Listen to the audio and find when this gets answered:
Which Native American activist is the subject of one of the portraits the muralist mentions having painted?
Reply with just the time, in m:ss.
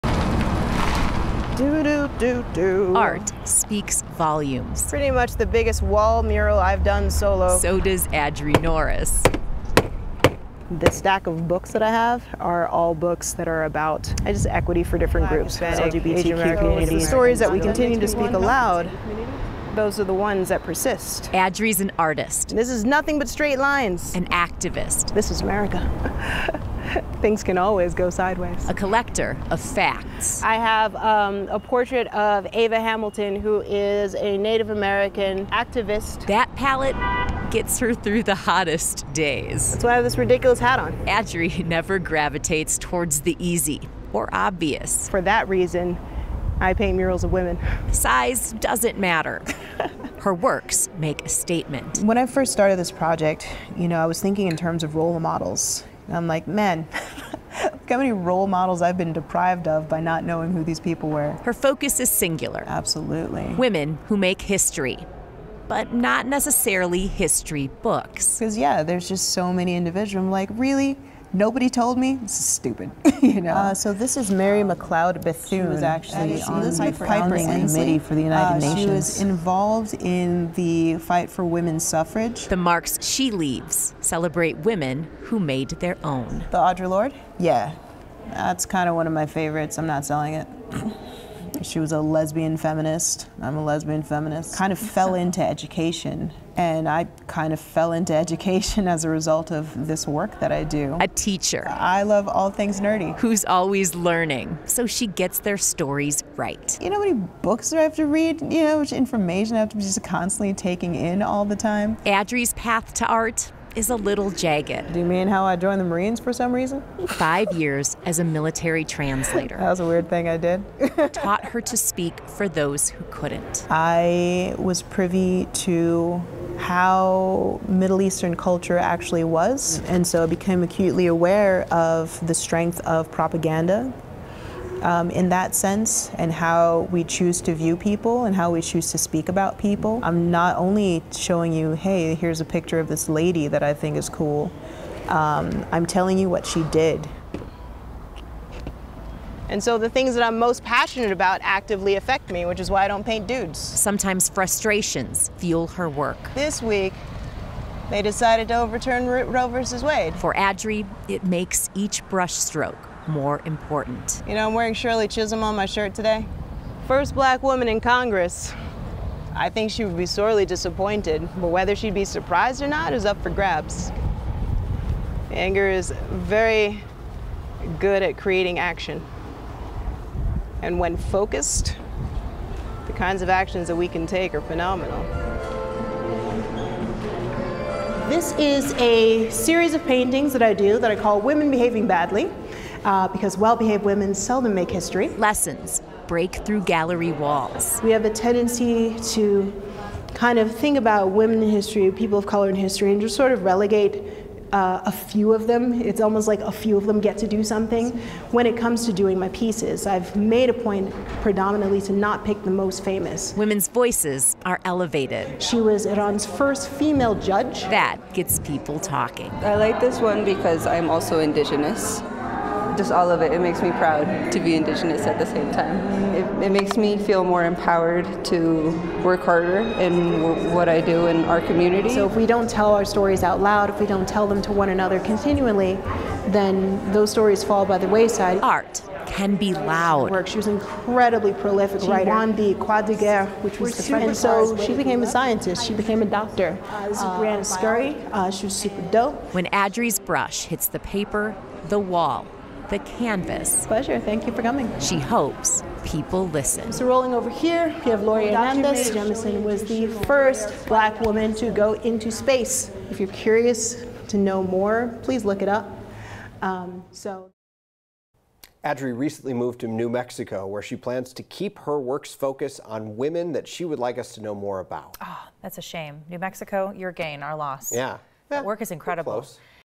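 0:32.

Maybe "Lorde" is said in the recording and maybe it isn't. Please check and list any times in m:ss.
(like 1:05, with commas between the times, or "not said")
1:26.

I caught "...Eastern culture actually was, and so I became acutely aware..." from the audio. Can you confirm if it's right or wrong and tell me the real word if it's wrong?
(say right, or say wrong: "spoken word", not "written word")
right.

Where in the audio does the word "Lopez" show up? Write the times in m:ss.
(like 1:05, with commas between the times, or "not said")
not said.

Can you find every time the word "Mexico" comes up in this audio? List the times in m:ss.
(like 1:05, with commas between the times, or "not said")
4:29, 4:36.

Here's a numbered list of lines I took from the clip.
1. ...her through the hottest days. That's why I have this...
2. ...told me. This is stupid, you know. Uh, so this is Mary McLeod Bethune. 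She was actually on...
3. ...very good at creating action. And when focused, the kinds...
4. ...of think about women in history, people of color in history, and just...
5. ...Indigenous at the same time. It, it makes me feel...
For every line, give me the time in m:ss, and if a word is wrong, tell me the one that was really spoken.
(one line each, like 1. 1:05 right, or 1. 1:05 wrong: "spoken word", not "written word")
1. 0:37 right
2. 1:11 right
3. 2:56 right
4. 3:20 right
5. 3:44 right.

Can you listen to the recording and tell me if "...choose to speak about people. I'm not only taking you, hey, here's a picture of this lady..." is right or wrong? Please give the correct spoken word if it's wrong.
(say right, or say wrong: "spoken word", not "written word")
wrong: "showing", not "taking".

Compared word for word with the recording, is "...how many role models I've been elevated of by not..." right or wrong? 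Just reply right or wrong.
wrong.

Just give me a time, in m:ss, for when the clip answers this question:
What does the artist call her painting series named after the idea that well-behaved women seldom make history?
3:11.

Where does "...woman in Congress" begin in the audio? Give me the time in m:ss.
2:47.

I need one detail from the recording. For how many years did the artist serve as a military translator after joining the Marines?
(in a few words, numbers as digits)
5.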